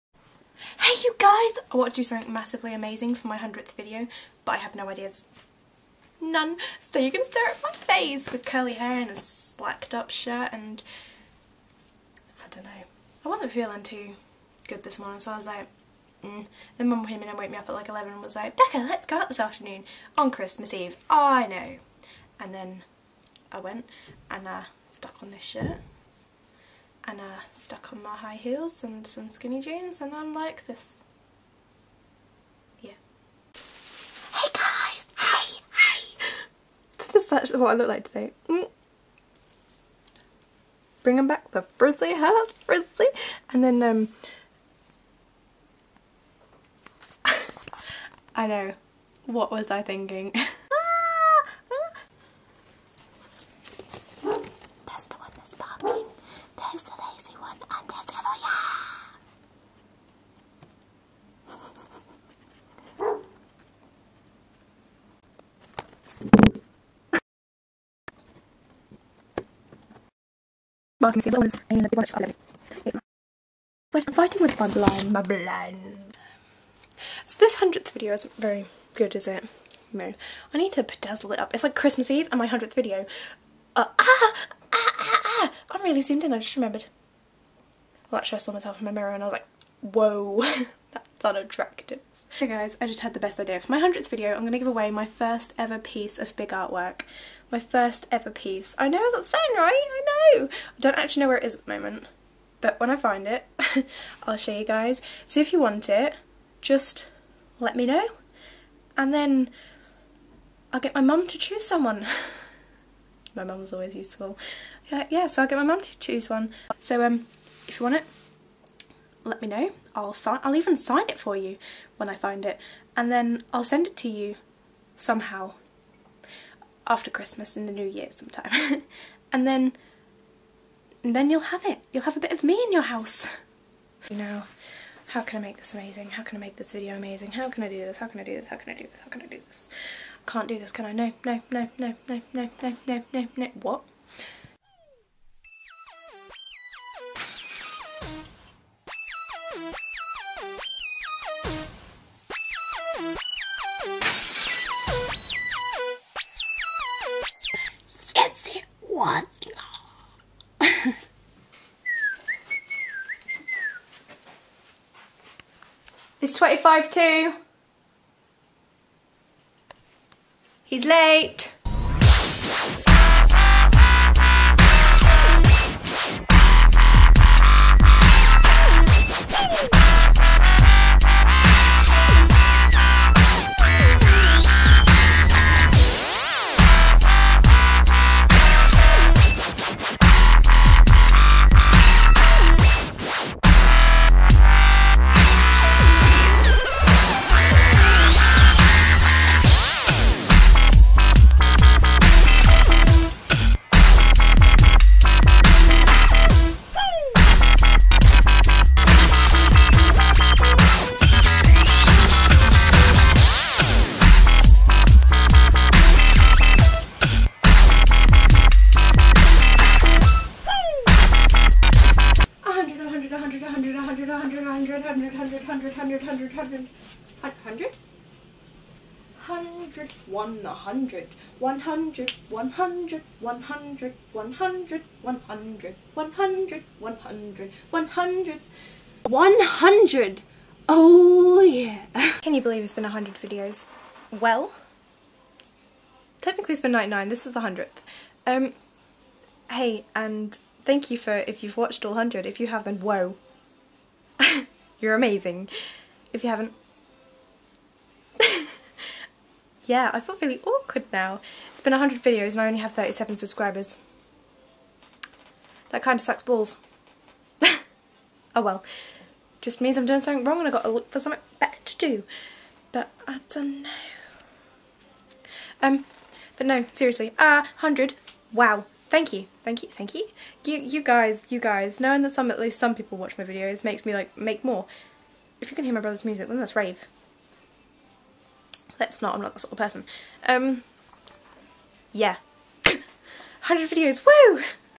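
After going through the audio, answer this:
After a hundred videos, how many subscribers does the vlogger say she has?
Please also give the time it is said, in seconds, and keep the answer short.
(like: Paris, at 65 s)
37, at 262 s.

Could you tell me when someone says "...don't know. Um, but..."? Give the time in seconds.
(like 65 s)
273 s.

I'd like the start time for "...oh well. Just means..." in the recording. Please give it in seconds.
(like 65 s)
268 s.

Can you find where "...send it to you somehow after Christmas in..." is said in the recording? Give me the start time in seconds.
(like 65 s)
123 s.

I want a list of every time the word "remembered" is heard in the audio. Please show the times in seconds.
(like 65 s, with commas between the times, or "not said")
86 s.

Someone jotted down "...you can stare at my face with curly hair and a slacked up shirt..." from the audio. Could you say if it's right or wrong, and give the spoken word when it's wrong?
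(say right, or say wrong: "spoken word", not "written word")
right.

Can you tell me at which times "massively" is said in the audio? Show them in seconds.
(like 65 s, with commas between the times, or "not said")
2 s.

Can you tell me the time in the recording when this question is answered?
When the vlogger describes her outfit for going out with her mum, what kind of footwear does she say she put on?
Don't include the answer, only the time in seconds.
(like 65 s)
28 s.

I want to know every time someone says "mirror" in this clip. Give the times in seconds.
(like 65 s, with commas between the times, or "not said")
88 s.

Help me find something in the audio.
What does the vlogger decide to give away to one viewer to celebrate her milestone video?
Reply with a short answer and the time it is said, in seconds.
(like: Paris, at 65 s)
first ever piece of big artwork, at 95 s.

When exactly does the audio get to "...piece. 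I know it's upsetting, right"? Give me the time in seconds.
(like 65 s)
98 s.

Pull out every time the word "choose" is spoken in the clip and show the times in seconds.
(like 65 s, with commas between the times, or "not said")
111 s, 115 s.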